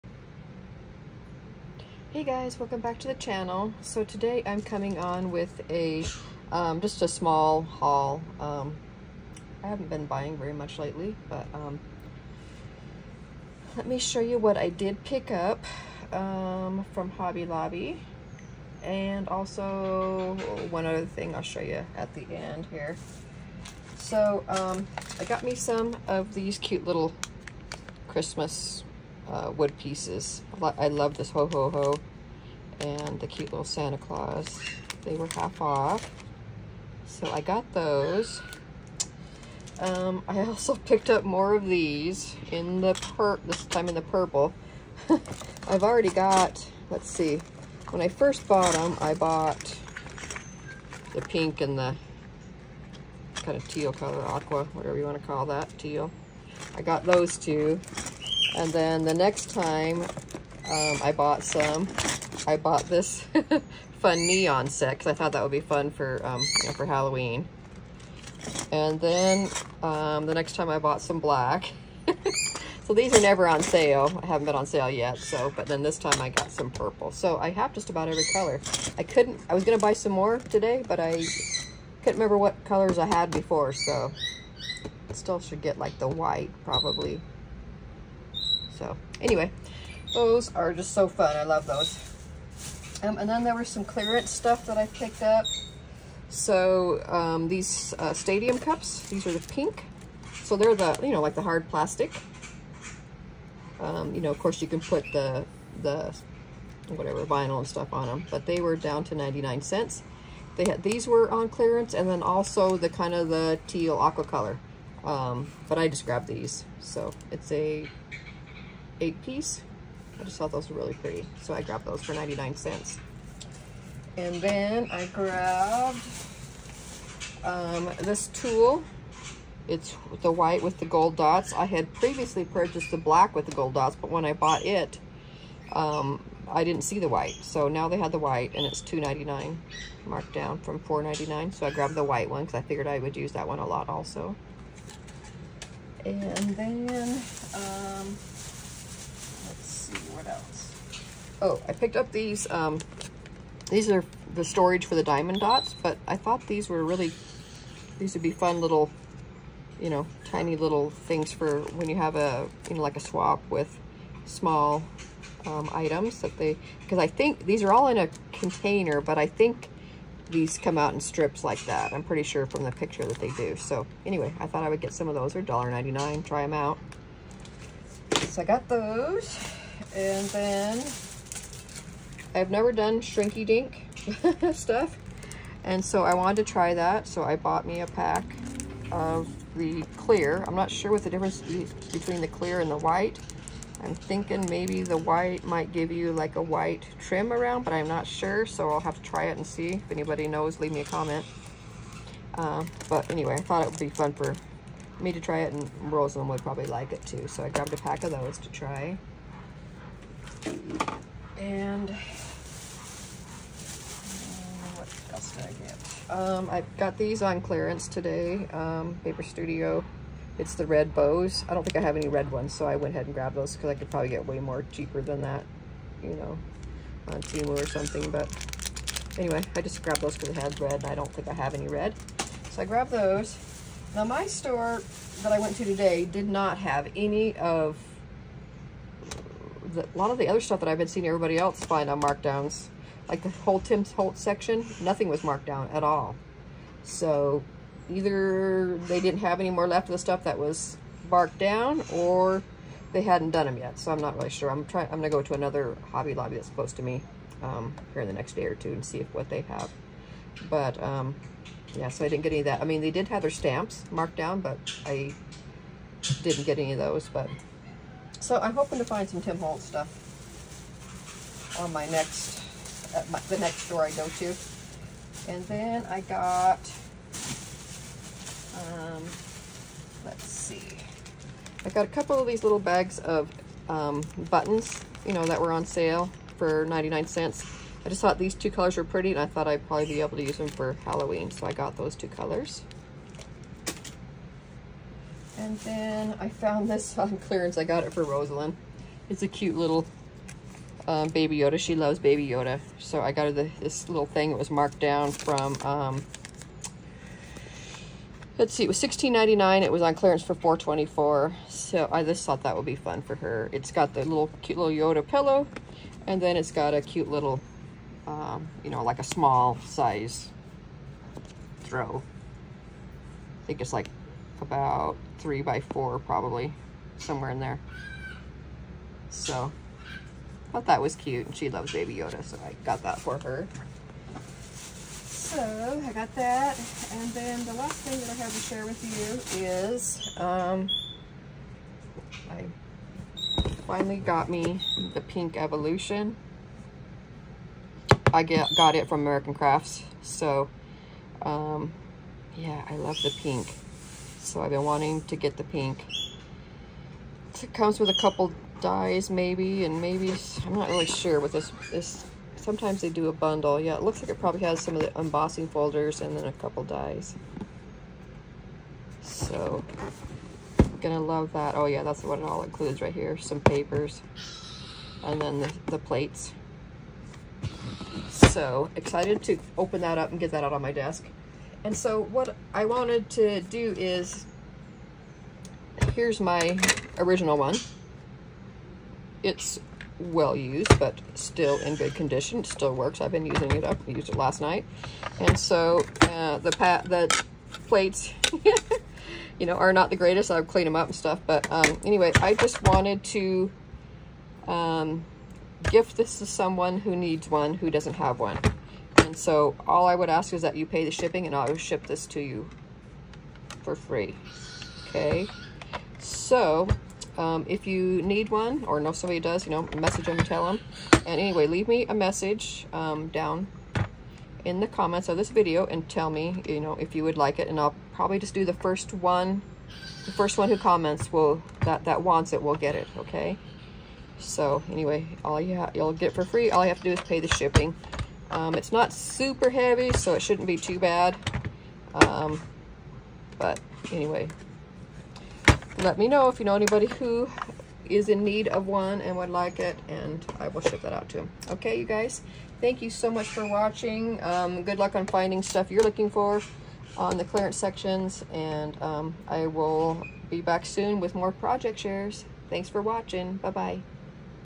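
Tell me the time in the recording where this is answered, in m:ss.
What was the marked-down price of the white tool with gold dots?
2:18.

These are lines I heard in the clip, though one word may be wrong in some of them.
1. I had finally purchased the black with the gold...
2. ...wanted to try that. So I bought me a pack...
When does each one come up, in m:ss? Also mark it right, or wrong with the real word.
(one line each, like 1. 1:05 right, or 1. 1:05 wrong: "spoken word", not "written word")
1. 2:11 wrong: "previously", not "finally"
2. 3:06 right.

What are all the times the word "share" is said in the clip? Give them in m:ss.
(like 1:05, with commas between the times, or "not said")
5:38, 7:41.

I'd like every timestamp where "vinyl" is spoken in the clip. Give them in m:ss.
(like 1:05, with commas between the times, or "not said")
1:47.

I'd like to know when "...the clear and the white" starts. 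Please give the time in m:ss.
3:12.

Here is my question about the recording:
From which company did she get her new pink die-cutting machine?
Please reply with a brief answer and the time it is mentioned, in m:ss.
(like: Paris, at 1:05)
American Crafts, at 5:49.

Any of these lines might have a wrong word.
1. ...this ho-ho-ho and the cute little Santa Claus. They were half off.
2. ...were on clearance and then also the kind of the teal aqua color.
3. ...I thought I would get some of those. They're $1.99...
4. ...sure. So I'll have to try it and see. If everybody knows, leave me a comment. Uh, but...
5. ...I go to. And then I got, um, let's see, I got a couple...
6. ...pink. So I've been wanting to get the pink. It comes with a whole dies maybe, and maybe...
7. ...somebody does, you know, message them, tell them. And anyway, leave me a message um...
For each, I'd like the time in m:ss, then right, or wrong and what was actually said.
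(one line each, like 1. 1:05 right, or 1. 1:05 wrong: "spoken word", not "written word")
1. 0:31 right
2. 1:51 right
3. 2:54 right
4. 3:18 wrong: "anybody", not "everybody"
5. 4:33 right
6. 5:53 wrong: "couple", not "whole"
7. 6:58 right.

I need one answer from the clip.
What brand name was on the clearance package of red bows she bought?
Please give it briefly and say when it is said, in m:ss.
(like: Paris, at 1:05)
Paper Studio, at 3:39.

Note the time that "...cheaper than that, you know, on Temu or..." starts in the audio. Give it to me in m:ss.
3:44.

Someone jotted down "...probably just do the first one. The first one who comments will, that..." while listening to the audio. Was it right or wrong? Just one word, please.
right.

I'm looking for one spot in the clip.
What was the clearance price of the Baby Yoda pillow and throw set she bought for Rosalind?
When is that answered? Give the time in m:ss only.
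5:10.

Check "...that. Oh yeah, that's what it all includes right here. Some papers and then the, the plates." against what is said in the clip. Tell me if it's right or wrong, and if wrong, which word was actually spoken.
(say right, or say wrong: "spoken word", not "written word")
right.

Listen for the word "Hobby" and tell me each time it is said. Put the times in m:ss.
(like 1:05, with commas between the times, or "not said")
0:17, 4:15.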